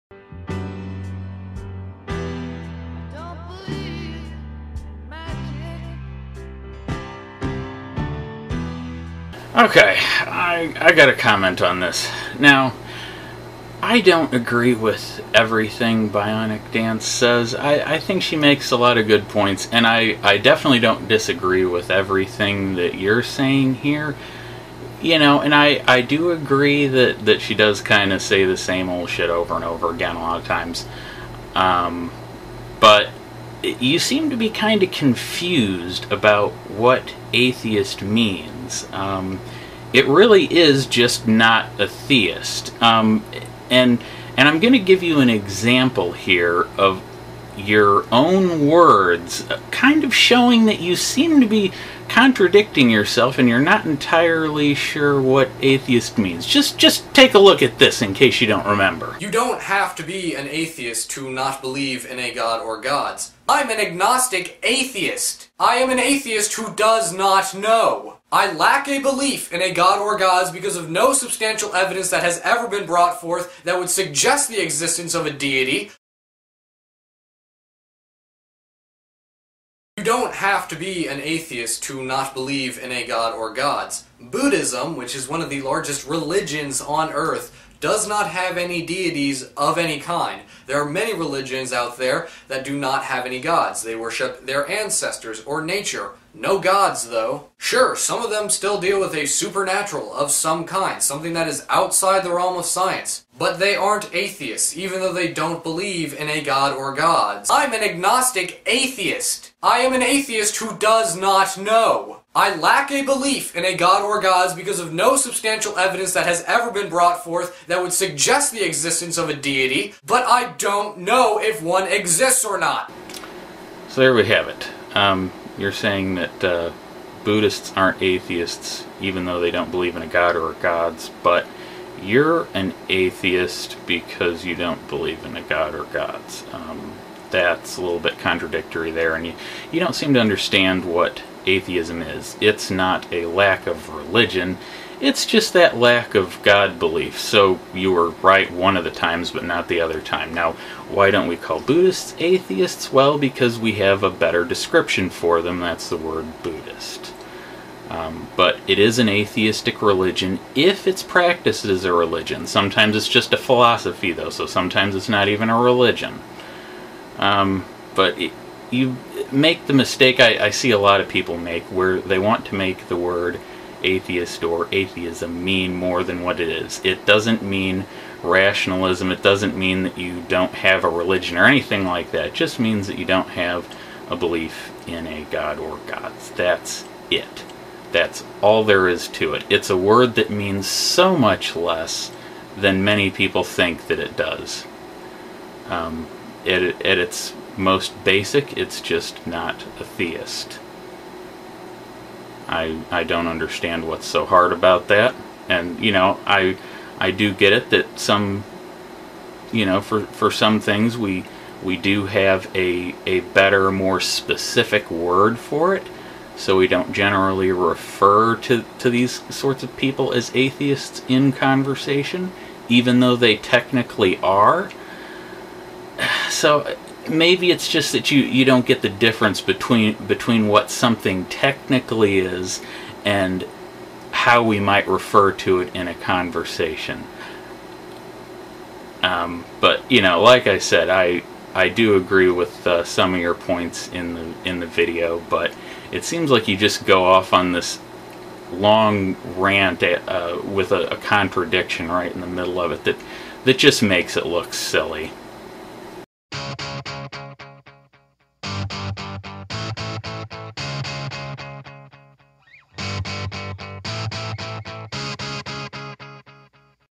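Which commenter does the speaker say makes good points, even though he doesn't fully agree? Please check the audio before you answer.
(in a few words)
Bionic Dance.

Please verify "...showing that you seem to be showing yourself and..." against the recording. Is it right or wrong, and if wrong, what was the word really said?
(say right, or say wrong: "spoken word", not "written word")
wrong: "contradicting", not "showing".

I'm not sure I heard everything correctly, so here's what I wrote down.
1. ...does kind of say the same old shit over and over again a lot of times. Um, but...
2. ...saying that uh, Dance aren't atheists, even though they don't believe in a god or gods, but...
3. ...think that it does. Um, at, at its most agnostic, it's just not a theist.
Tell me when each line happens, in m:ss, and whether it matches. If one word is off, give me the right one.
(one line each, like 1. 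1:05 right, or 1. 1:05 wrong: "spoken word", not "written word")
1. 0:27 right
2. 2:05 wrong: "Buddhists", not "Dance"
3. 3:13 wrong: "basic", not "agnostic".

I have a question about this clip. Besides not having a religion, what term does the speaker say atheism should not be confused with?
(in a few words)
rationalism.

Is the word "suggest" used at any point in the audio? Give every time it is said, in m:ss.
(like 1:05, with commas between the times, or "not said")
1:13, 1:57.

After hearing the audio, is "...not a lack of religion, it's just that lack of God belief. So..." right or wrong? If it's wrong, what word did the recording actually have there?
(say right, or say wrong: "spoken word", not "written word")
right.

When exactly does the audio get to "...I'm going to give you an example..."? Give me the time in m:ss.
0:44.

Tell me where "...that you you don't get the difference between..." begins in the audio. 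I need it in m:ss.
3:47.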